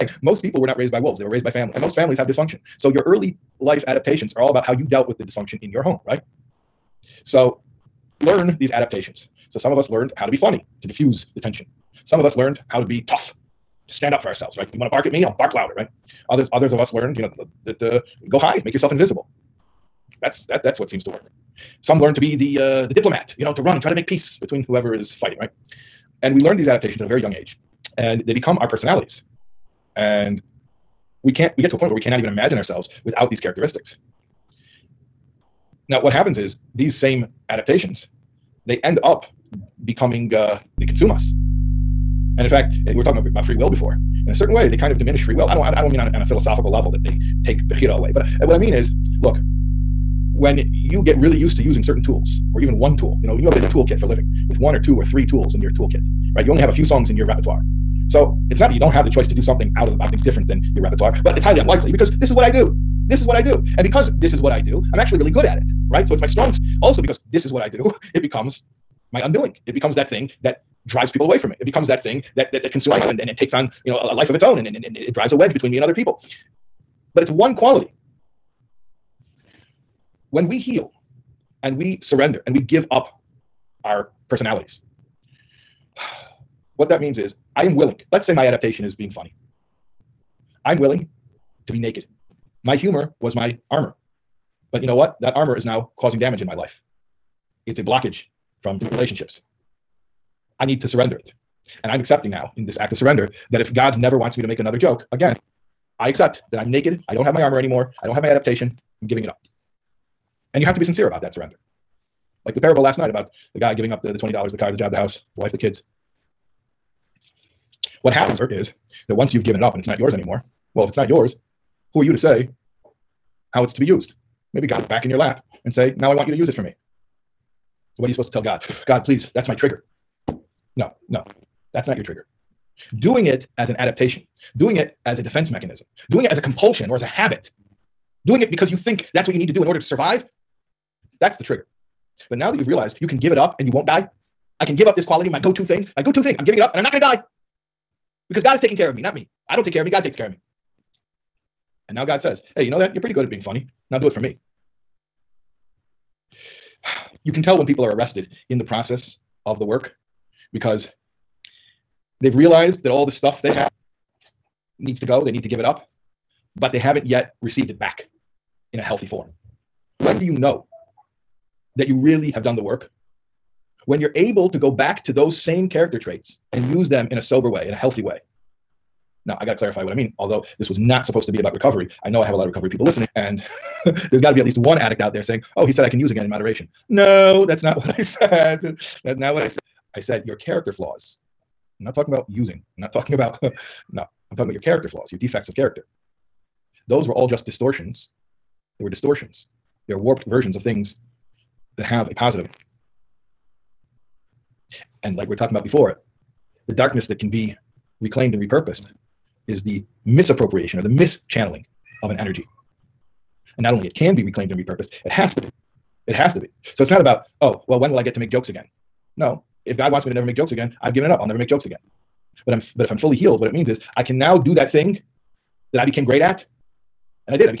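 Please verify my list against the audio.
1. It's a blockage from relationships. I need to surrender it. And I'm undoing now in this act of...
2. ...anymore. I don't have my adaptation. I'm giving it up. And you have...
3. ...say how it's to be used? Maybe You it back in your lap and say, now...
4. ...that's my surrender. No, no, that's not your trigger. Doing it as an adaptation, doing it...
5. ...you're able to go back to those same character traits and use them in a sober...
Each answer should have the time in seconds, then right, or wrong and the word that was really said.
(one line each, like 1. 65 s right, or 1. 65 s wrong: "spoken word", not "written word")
1. 97 s wrong: "accepting", not "undoing"
2. 107 s right
3. 122 s wrong: "God", not "You"
4. 129 s wrong: "trigger", not "surrender"
5. 173 s right.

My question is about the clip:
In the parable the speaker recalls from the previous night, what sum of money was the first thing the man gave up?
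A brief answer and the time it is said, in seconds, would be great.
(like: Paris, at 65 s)
$20, at 114 s.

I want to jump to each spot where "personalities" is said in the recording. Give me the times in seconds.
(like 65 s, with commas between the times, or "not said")
28 s, 84 s.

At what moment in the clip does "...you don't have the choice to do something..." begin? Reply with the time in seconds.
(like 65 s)
58 s.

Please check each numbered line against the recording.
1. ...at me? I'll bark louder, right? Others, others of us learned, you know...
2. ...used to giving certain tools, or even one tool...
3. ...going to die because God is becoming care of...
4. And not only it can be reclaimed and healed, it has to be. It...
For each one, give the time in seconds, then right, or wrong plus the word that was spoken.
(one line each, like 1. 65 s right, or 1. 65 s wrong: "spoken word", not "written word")
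1. 15 s right
2. 51 s wrong: "using", not "giving"
3. 146 s wrong: "taking", not "becoming"
4. 213 s wrong: "repurposed", not "healed".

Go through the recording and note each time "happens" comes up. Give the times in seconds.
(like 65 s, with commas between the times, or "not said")
36 s, 118 s.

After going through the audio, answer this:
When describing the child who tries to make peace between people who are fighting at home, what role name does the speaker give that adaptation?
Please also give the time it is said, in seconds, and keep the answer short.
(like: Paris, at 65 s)
the diplomat, at 22 s.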